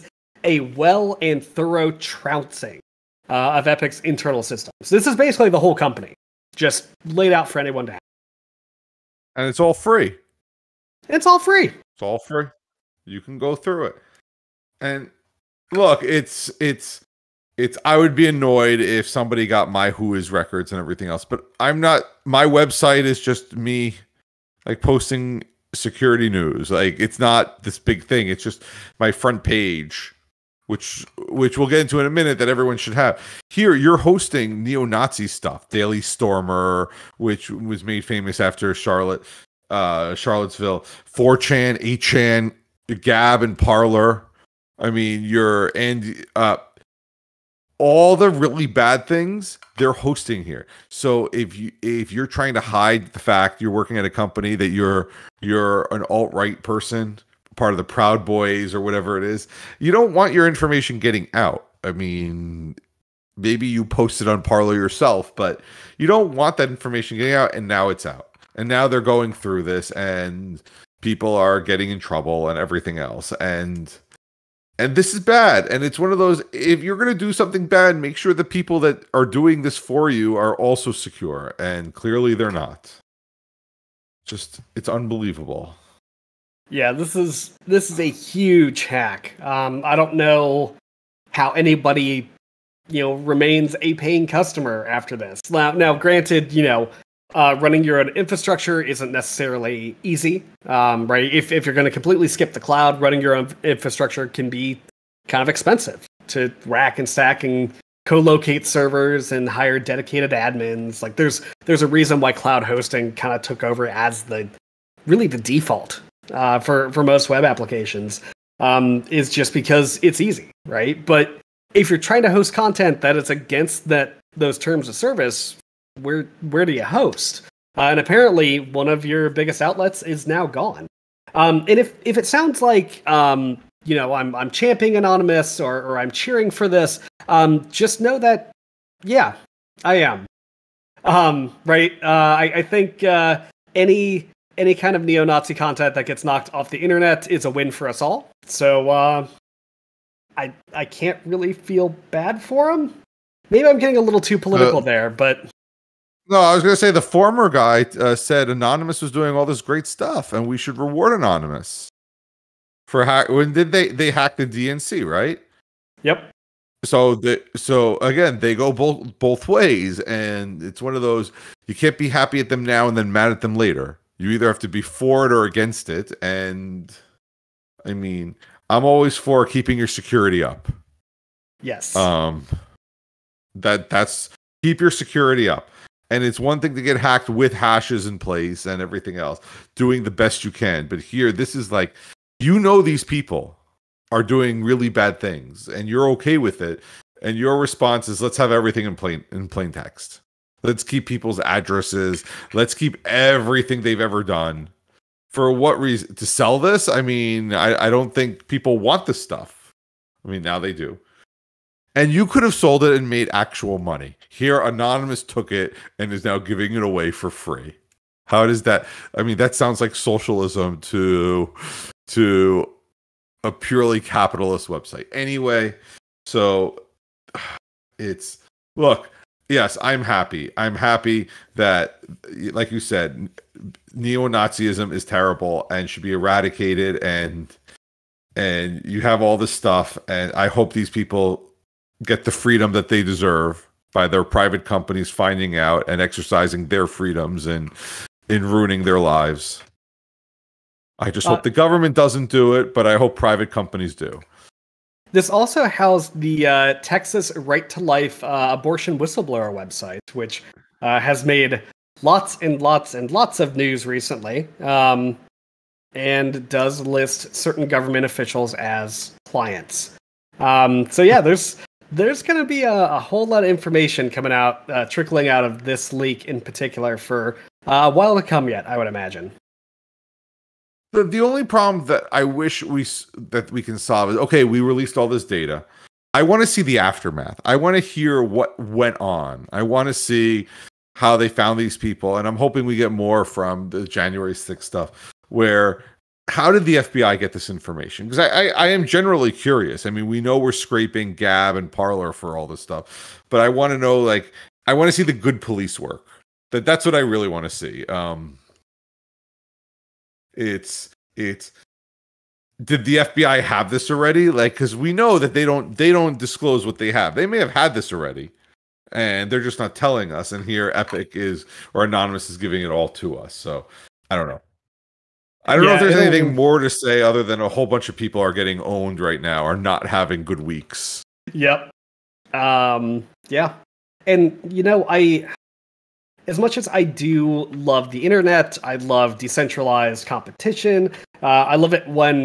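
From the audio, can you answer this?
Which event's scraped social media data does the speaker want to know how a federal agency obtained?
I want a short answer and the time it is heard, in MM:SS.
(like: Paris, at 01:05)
January 6th, at 04:53.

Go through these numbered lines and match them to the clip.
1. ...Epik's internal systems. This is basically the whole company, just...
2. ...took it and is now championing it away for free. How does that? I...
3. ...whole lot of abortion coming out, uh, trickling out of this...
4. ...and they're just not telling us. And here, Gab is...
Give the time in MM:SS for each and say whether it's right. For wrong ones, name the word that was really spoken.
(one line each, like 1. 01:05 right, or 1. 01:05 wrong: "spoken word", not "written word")
1. 00:03 right
2. 03:35 wrong: "giving", not "championing"
3. 04:32 wrong: "information", not "abortion"
4. 05:18 wrong: "Epik", not "Gab".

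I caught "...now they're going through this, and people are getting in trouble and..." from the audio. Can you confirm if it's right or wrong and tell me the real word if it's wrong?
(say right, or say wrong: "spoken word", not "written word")
right.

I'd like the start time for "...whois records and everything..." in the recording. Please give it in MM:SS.
00:19.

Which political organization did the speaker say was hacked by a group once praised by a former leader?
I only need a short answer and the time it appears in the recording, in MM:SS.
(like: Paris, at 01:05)
The DNC, at 02:44.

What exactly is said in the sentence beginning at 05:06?
That that's what I really want to see.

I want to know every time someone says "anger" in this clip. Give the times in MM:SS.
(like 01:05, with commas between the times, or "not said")
not said.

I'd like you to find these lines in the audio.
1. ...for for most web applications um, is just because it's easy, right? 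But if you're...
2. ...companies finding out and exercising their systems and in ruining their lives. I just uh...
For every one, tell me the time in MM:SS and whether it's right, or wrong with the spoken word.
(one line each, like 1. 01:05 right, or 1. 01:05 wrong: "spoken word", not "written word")
1. 01:56 right
2. 04:04 wrong: "freedoms", not "systems".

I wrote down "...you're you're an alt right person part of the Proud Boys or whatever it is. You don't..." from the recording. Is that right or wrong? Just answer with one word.
right.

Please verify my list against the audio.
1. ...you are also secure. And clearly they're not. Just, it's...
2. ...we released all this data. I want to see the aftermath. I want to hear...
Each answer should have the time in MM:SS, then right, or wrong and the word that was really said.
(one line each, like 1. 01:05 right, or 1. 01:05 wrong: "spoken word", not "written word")
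1. 01:20 right
2. 04:44 right.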